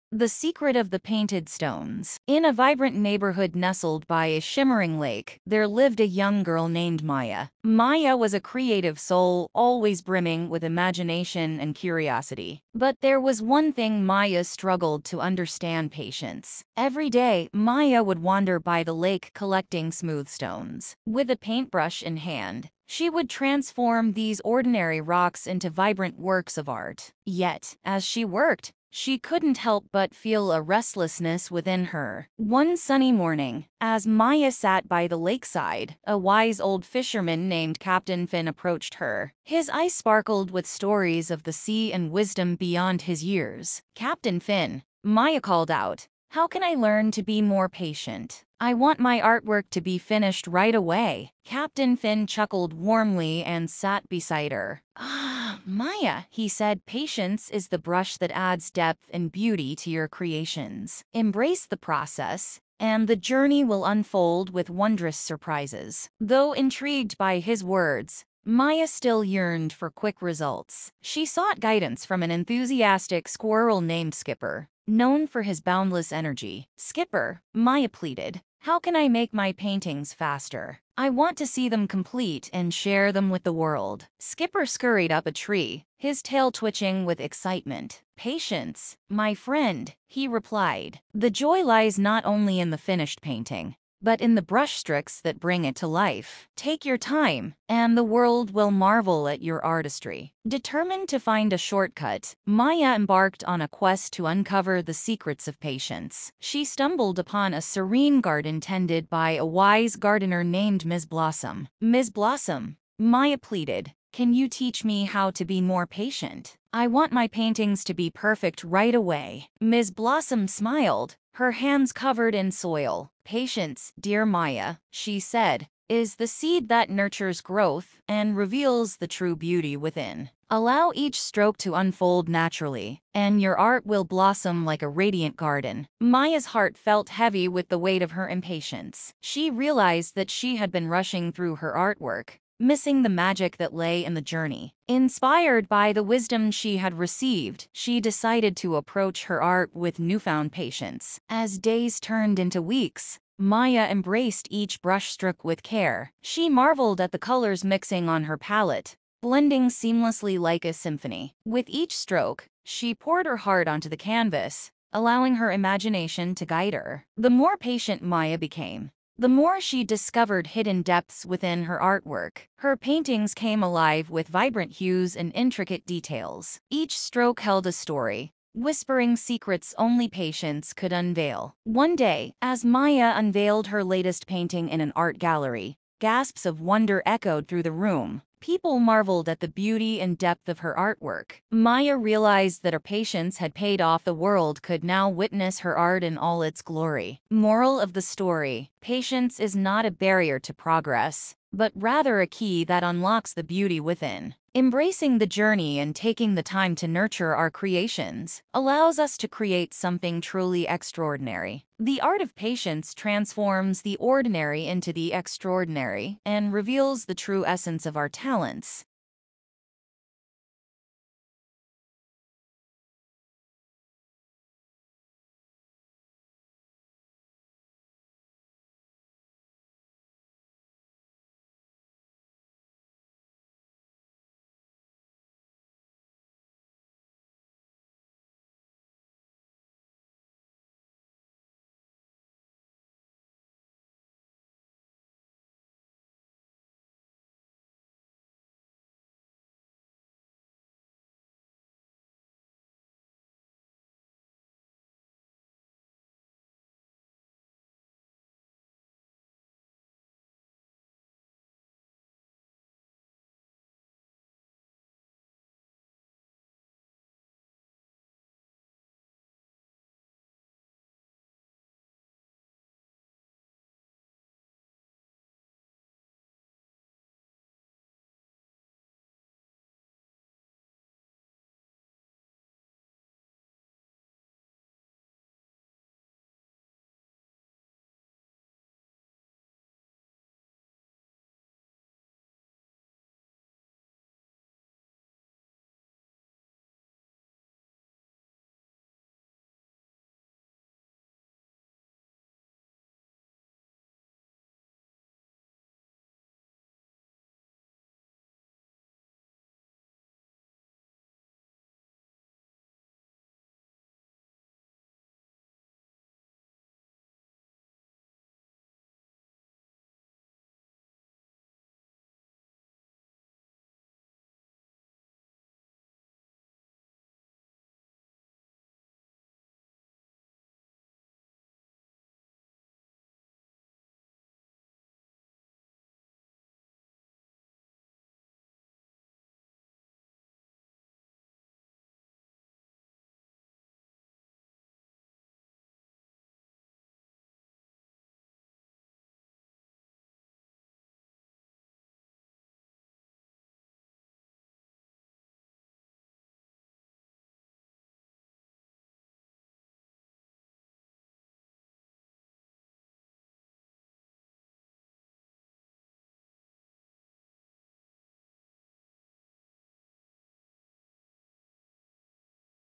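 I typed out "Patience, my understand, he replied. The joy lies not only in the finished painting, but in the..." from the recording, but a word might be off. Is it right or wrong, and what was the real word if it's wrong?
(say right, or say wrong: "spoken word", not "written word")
wrong: "friend", not "understand".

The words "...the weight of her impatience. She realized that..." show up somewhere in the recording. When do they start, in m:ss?
2:17.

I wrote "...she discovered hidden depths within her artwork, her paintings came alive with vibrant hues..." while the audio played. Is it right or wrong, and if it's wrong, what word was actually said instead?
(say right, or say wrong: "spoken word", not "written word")
right.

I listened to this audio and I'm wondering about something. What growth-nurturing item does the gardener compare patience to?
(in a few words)
The seed.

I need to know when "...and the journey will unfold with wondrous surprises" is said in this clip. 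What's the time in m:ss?
1:02.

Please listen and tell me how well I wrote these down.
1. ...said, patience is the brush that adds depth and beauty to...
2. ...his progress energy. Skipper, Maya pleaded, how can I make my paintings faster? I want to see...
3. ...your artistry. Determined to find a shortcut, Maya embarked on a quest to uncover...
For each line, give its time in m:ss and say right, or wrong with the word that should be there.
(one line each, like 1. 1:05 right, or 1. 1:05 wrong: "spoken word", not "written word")
1. 0:56 right
2. 1:15 wrong: "boundless", not "progress"
3. 1:39 right.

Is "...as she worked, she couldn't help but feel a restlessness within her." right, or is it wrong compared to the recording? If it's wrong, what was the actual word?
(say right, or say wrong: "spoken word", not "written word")
right.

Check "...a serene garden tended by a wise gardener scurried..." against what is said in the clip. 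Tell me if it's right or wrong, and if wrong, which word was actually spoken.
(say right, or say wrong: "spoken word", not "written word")
wrong: "named", not "scurried".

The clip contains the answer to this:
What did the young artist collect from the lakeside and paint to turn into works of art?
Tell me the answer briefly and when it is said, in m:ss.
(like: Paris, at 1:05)
Smooth stones, at 0:19.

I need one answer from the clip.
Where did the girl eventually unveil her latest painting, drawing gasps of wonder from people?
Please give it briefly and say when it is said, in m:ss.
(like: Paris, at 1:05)
An art gallery, at 3:04.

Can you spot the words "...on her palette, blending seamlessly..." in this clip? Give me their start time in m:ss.
2:38.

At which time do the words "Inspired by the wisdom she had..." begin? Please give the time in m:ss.
2:24.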